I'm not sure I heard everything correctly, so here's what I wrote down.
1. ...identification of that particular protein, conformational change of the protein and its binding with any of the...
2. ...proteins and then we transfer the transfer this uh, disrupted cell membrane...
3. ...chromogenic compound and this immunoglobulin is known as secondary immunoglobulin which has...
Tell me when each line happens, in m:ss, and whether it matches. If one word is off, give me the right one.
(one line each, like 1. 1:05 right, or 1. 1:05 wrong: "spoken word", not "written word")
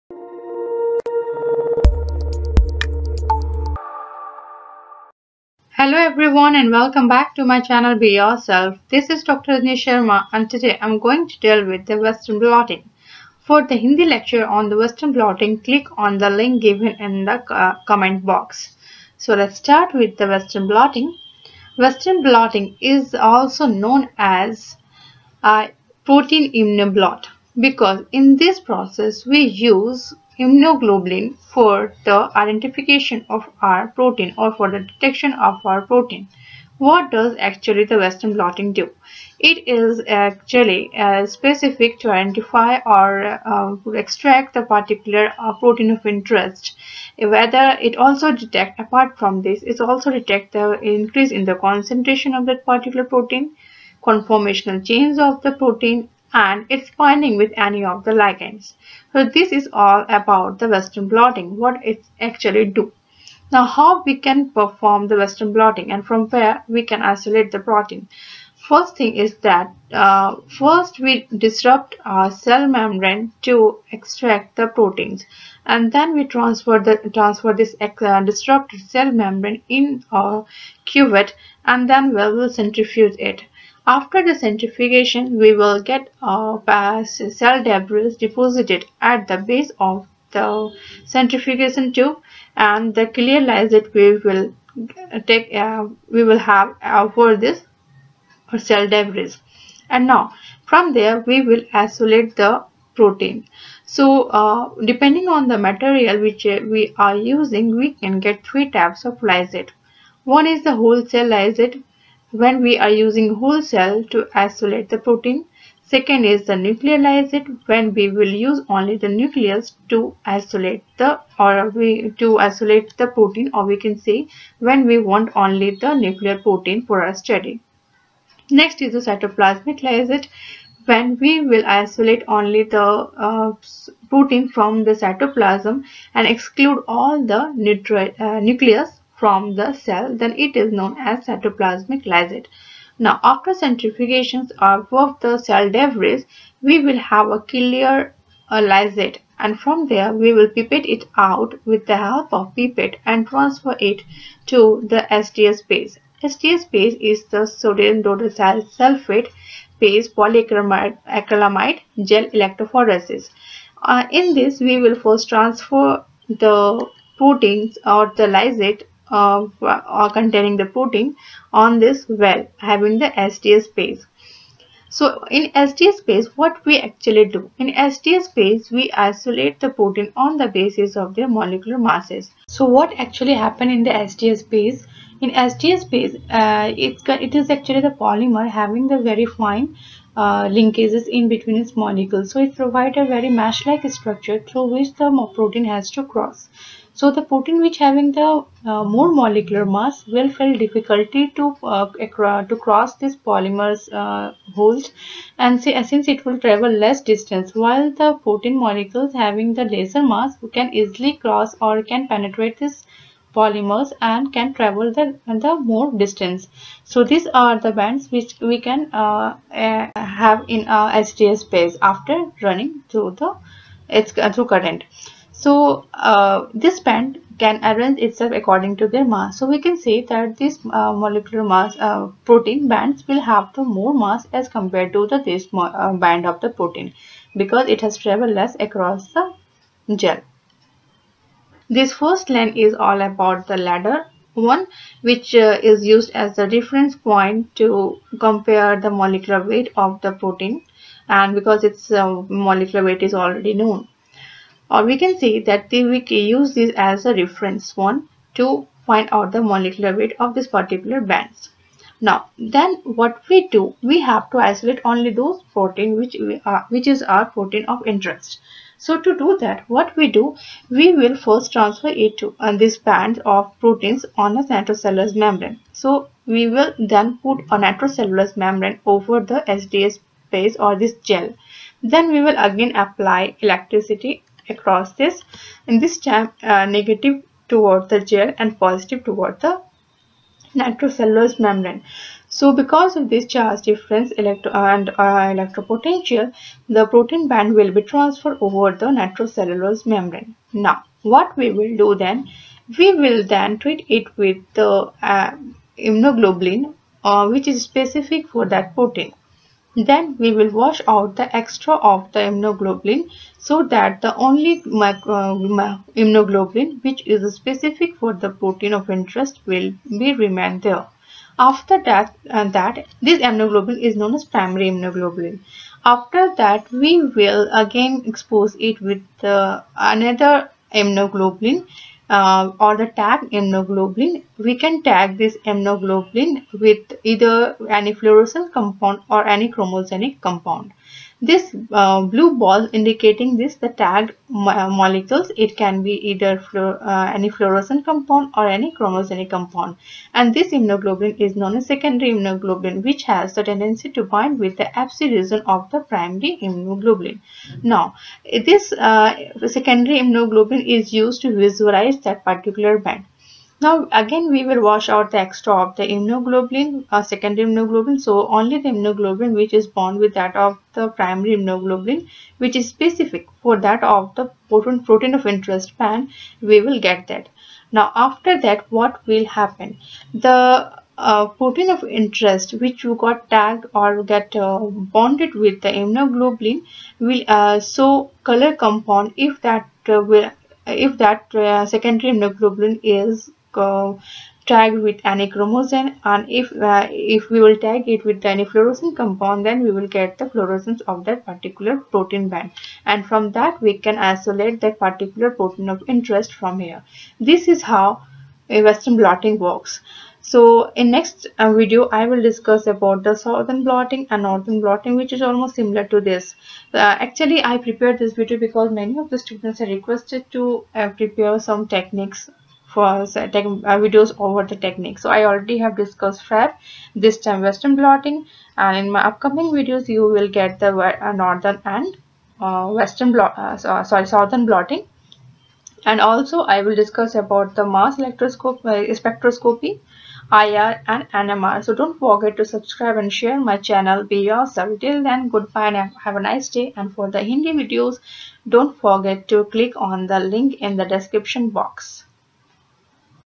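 1. 0:51 wrong: "concentration", not "identification"
2. 1:14 right
3. 5:48 right.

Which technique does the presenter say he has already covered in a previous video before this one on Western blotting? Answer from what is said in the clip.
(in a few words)
FAB.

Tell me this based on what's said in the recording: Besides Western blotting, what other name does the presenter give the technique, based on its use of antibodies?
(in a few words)
protein immunoblot.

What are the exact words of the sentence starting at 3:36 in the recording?
So these are the bands which we can uh, uh, have in our SDS-PAGE after running through the it's, uh, through current.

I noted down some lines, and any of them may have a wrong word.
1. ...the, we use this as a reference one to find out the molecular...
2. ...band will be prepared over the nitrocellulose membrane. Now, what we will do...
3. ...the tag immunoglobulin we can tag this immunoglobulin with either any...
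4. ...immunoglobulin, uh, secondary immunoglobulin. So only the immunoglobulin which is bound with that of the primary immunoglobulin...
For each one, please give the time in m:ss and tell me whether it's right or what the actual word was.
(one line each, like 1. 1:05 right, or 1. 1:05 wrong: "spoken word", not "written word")
1. 4:15 right
2. 4:57 wrong: "transferred", not "prepared"
3. 5:32 right
4. 6:05 right.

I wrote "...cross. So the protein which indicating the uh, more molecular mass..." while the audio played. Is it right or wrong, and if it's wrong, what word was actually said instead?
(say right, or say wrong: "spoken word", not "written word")
wrong: "having", not "indicating".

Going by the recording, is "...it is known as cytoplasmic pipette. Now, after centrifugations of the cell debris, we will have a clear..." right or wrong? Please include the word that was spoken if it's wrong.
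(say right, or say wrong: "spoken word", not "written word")
wrong: "lysate", not "pipette".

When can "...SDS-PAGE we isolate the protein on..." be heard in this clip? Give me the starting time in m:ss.
2:57.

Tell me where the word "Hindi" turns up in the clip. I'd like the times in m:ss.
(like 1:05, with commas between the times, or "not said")
0:13, 7:27.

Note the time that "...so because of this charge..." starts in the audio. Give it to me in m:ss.
4:52.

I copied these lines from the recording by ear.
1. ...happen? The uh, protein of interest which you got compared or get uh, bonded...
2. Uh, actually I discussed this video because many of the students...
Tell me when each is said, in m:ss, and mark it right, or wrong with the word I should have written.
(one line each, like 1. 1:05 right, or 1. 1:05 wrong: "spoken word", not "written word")
1. 6:19 wrong: "tagged", not "compared"
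2. 6:56 wrong: "prepared", not "discussed".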